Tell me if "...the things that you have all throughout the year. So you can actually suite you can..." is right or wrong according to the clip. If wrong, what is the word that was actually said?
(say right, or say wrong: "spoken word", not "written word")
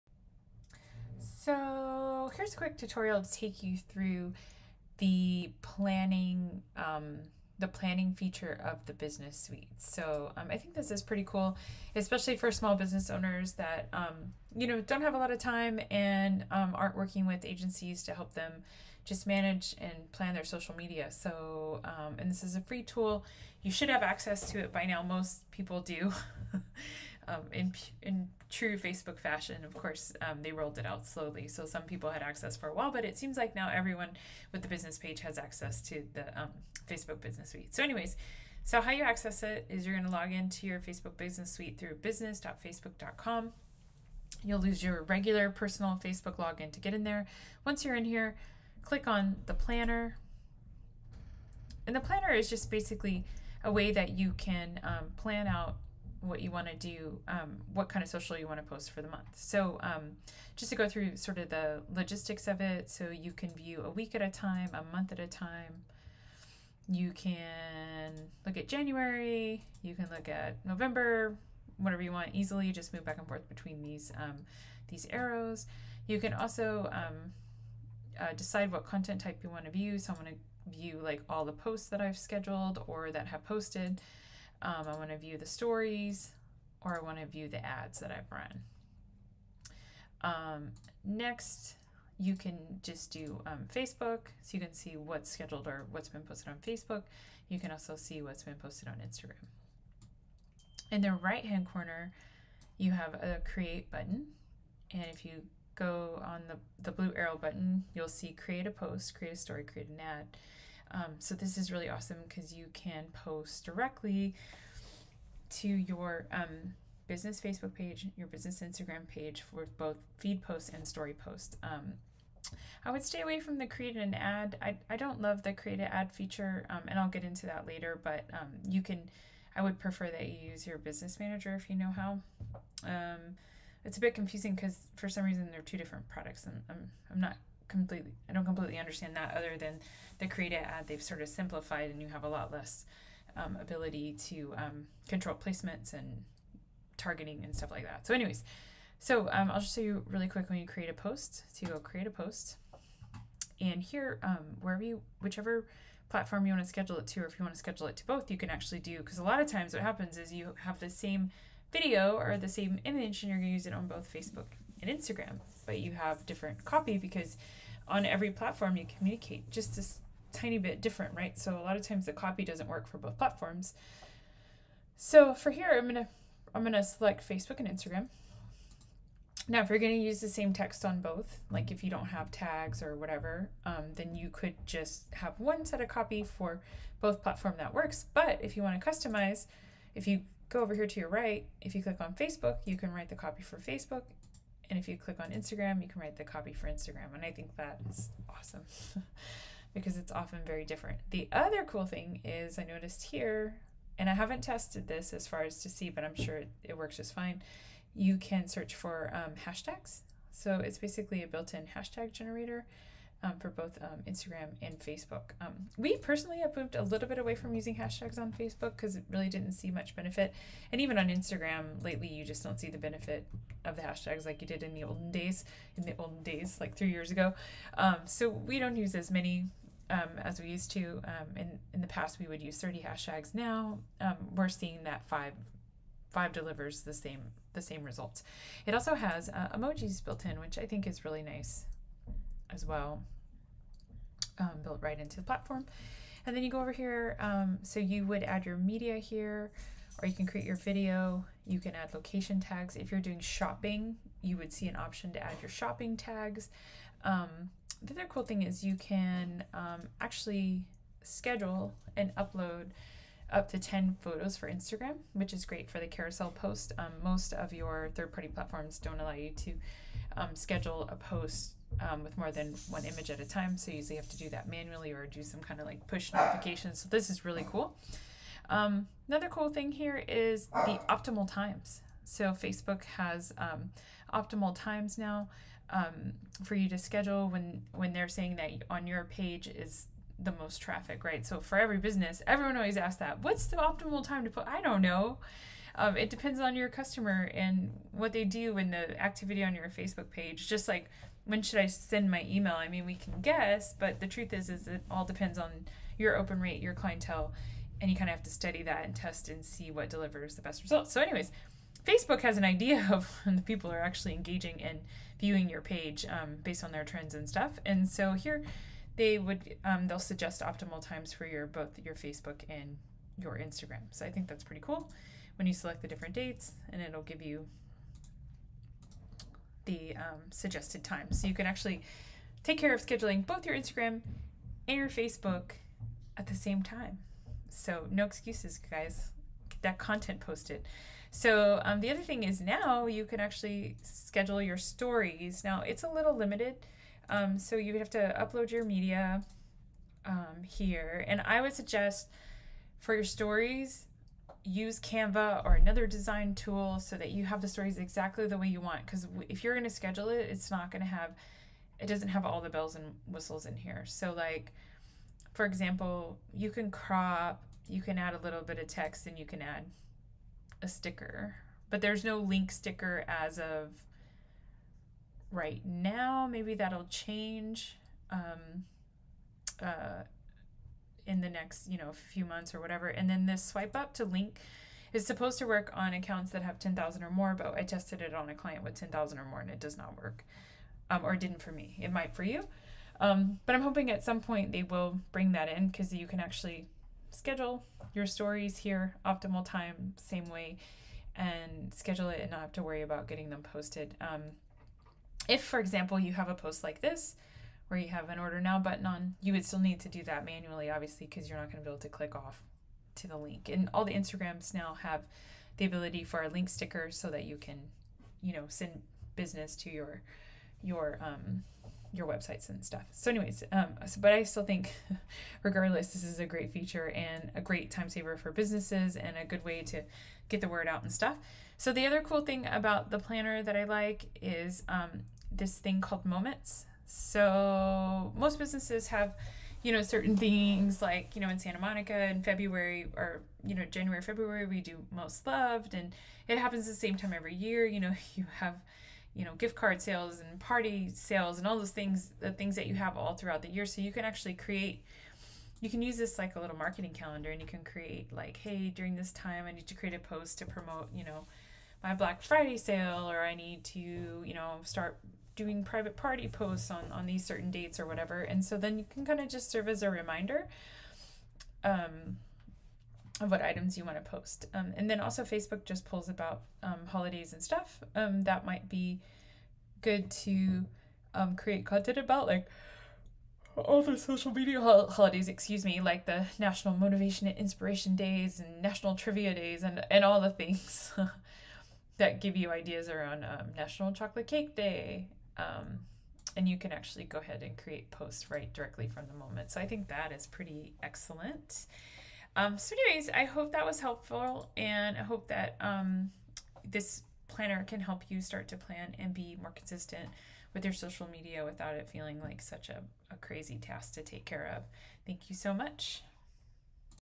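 wrong: "create", not "suite".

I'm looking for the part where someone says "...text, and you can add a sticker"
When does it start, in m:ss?
6:08.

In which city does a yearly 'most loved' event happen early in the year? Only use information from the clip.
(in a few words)
Santa Monica.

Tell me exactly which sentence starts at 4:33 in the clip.
So you usually have to do that manually or do some kind of like push notifications.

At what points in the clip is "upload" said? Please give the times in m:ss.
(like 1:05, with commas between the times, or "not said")
4:22, 5:48.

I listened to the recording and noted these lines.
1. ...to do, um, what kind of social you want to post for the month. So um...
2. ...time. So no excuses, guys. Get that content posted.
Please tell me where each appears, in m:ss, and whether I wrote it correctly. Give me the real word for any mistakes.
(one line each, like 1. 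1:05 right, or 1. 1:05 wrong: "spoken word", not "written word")
1. 0:56 right
2. 5:36 right.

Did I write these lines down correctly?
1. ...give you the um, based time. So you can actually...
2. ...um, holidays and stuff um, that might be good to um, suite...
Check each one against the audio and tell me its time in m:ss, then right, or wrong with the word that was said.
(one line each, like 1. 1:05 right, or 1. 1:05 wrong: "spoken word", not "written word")
1. 5:27 wrong: "suggested", not "based"
2. 7:56 wrong: "create", not "suite".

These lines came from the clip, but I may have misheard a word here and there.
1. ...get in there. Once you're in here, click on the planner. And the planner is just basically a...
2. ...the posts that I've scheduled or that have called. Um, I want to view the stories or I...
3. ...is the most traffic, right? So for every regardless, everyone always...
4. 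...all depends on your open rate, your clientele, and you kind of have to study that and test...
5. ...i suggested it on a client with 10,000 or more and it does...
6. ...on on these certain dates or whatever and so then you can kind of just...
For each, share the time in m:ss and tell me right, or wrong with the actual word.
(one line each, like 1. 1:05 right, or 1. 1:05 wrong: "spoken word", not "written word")
1. 0:46 right
2. 1:21 wrong: "posted", not "called"
3. 4:49 wrong: "business", not "regardless"
4. 5:04 right
5. 6:27 wrong: "tested", not "suggested"
6. 7:46 right.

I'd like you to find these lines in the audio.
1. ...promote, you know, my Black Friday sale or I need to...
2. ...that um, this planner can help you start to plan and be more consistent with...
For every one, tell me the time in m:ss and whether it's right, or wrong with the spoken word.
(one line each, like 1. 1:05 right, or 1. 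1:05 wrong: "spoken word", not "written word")
1. 7:40 right
2. 8:25 right.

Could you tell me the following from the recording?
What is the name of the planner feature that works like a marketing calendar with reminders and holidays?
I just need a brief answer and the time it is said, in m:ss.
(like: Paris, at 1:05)
Moments, at 7:16.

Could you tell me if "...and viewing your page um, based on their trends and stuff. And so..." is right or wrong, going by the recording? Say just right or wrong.
right.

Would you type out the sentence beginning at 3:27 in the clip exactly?
You can search for um, hashtags.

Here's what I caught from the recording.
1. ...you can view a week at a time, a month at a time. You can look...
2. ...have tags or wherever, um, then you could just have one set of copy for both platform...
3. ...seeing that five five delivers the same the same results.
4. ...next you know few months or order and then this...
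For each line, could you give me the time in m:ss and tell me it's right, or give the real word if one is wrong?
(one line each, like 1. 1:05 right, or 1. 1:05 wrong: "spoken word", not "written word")
1. 1:03 right
2. 3:02 wrong: "whatever", not "wherever"
3. 3:54 right
4. 6:21 wrong: "whatever", not "order".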